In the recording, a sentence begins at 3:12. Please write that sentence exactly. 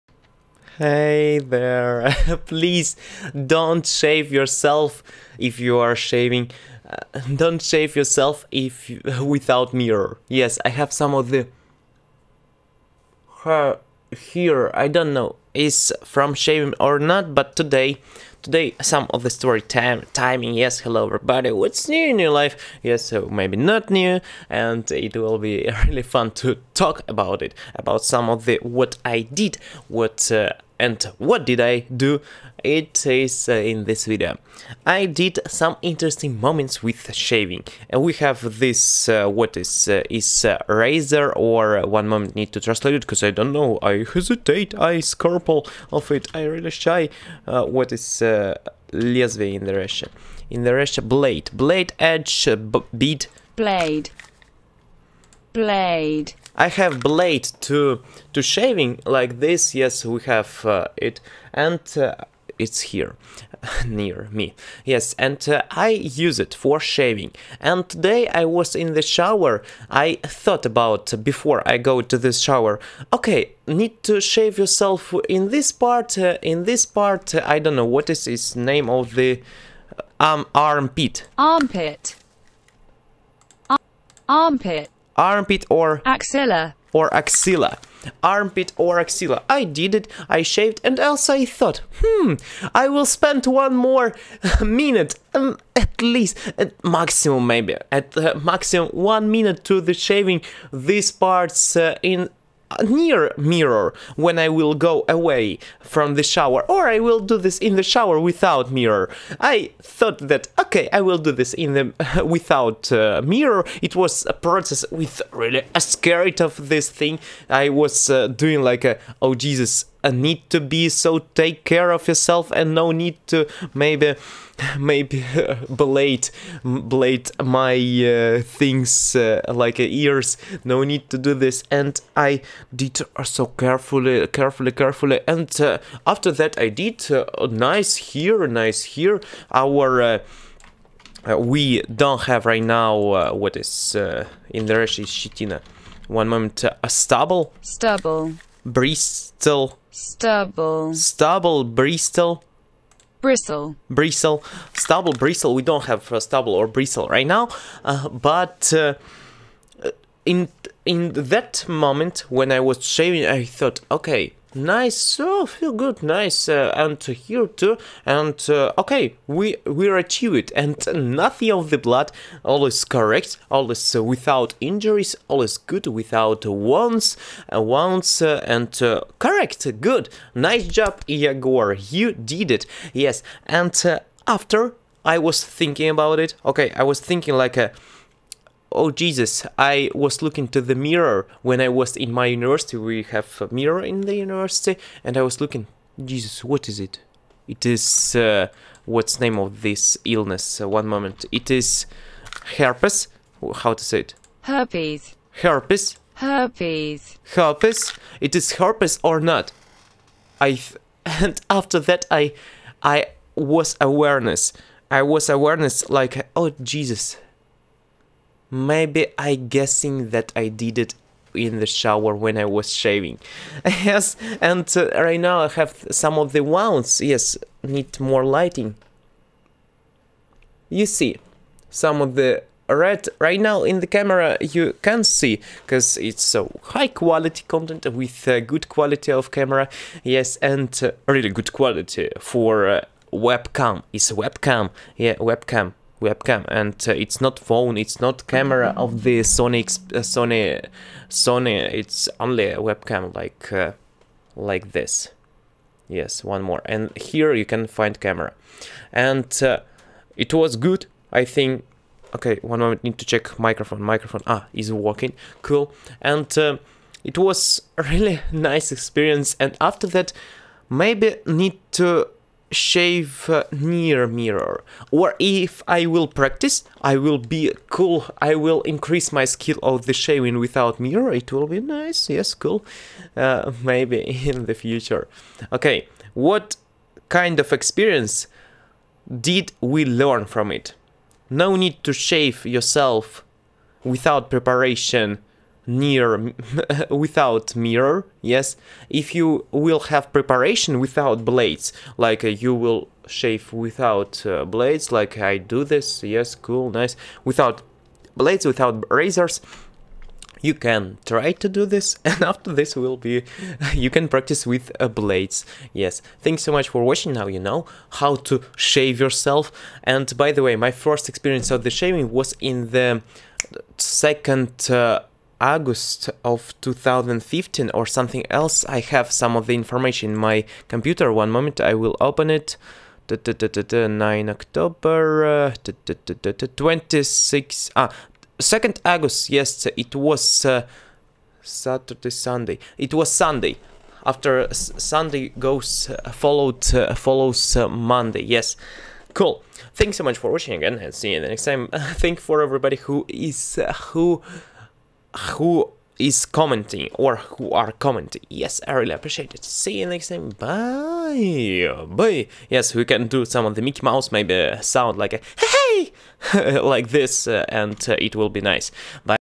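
We have a mirror in the university, and I was looking, Jesus, what is it?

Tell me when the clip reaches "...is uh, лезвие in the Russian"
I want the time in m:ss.
0:47.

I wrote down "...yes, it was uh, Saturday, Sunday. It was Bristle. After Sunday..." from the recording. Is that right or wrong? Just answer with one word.
wrong.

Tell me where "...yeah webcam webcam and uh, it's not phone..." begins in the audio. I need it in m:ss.
4:04.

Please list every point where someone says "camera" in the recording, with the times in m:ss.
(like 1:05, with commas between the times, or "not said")
3:53, 3:59, 4:08, 4:17.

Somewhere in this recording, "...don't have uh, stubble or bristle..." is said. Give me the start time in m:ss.
2:35.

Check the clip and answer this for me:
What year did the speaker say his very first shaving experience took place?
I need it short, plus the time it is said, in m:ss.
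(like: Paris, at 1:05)
2015, at 5:26.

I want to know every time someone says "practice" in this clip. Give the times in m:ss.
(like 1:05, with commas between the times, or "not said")
4:36, 5:14.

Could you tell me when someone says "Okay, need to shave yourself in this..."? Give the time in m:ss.
1:13.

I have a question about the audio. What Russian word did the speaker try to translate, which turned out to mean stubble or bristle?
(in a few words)
shitina.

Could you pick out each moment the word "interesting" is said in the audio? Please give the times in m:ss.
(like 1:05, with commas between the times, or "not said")
0:35.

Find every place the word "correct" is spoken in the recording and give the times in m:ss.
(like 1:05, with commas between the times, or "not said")
2:52, 2:59.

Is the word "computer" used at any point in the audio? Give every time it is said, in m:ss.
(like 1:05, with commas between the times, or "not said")
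5:30.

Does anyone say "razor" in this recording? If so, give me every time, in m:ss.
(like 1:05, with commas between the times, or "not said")
0:40, 5:08.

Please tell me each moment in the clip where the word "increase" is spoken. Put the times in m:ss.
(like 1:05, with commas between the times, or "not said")
4:38.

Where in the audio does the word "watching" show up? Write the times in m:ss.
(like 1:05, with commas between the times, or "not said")
5:16, 5:50.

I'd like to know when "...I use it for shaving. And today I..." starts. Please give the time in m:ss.
1:05.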